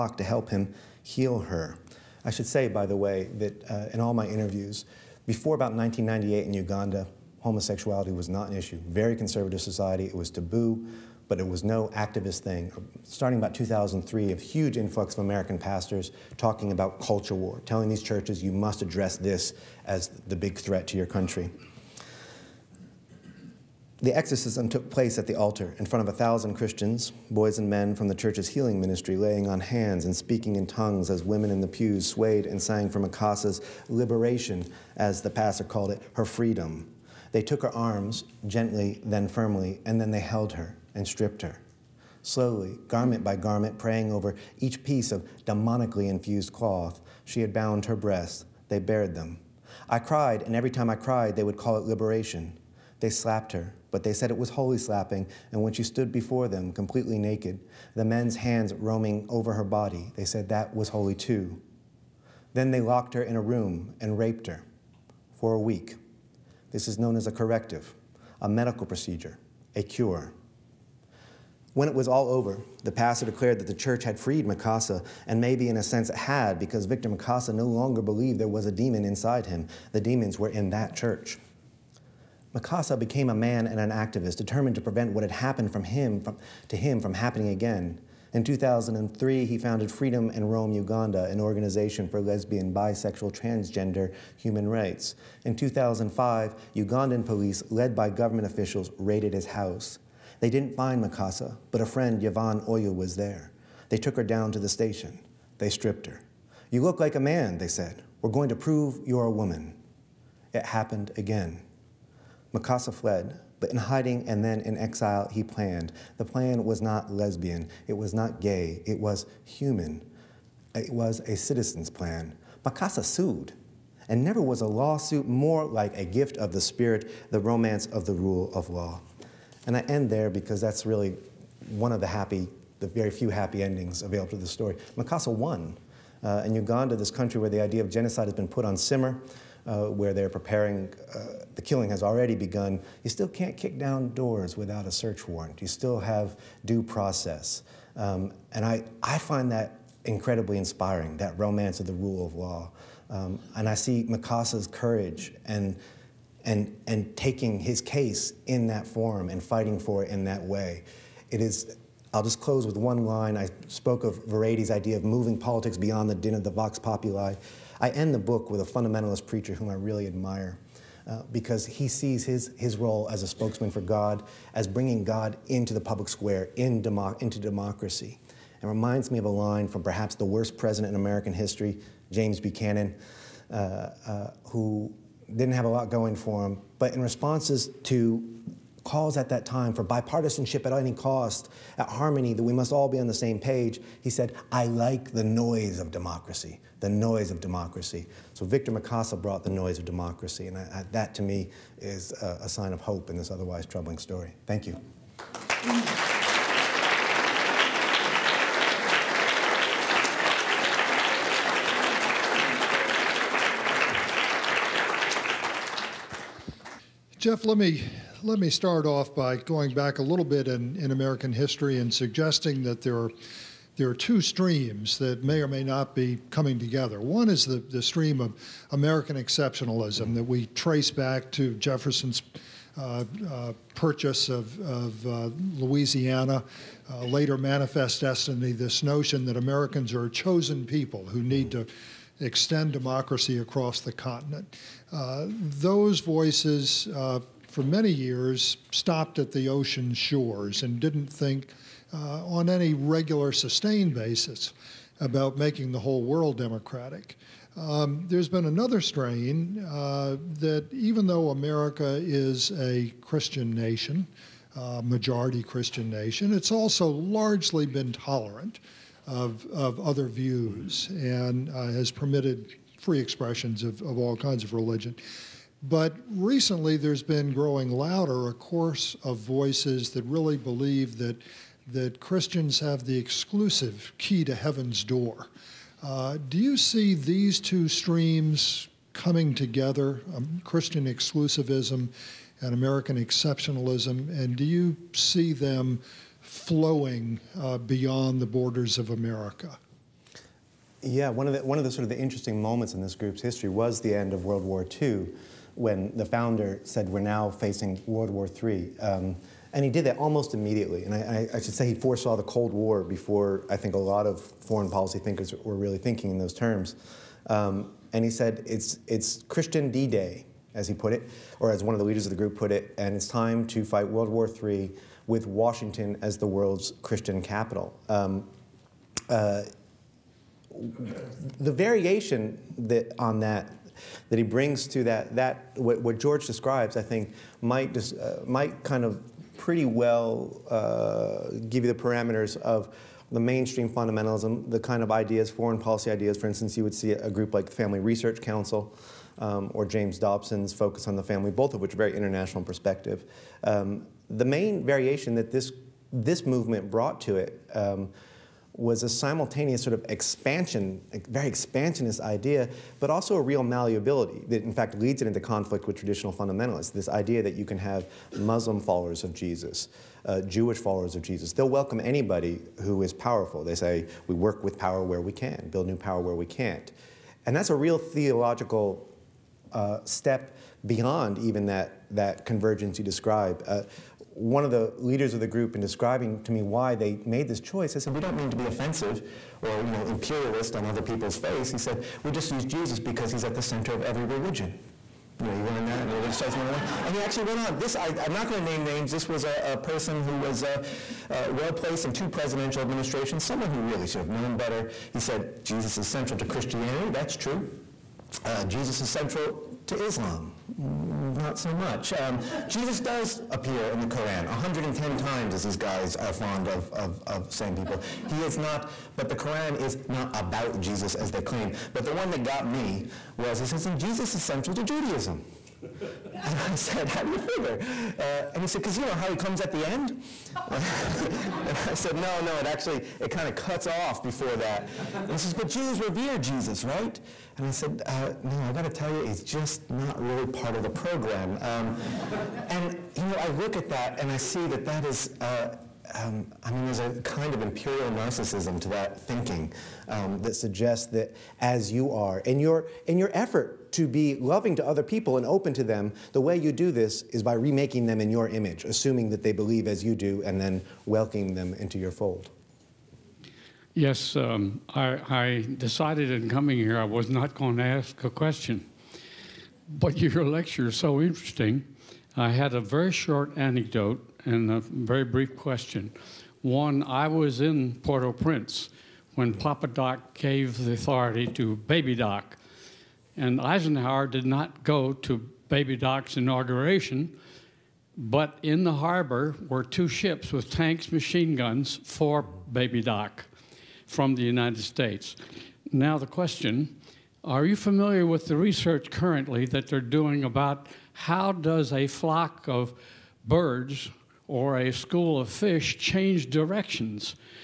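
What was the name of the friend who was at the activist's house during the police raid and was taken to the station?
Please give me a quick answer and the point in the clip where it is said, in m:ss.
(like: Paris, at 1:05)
Yvonne Oyoo, at 1:42.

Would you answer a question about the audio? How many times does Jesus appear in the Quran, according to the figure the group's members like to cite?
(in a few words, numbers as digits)
110.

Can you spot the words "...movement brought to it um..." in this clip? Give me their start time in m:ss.
5:56.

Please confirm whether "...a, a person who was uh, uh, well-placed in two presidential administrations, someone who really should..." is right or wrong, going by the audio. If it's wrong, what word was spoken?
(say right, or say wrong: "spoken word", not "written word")
right.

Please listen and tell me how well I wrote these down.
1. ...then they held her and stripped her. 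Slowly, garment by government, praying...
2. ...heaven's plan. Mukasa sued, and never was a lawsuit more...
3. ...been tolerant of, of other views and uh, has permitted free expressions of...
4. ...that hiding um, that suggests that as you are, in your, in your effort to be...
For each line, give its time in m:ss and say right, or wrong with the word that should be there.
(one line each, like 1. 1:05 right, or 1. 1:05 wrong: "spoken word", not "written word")
1. 0:39 wrong: "garment", not "government"
2. 2:01 wrong: "citizen", not "heaven"
3. 4:27 right
4. 7:28 wrong: "thinking", not "hiding".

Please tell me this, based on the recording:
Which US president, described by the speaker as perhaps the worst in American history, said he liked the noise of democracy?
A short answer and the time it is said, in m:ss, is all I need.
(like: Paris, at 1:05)
James Buchanan, at 3:02.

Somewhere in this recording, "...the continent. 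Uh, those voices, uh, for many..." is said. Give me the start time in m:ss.
4:03.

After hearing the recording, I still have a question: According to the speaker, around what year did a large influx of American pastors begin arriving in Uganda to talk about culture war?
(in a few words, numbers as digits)
2003.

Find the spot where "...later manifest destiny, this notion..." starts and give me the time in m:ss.
3:57.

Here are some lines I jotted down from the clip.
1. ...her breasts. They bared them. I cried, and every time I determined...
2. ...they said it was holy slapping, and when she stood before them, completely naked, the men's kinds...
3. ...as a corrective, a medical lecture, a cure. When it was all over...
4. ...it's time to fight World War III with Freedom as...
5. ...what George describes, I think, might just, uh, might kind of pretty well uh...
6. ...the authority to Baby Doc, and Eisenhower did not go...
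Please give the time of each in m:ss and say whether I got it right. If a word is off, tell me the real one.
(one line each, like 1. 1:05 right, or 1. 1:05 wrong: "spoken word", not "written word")
1. 0:47 wrong: "cried", not "determined"
2. 0:54 wrong: "hands", not "kinds"
3. 1:07 wrong: "procedure", not "lecture"
4. 5:22 wrong: "Washington", not "Freedom"
5. 5:35 right
6. 8:00 right.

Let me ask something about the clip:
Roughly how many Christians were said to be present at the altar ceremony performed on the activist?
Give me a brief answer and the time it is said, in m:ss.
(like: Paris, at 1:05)
1,000, at 0:26.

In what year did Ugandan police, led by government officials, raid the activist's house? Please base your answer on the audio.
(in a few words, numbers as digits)
2005.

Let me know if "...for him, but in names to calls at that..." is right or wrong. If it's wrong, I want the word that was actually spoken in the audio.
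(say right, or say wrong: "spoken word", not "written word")
wrong: "responses", not "names".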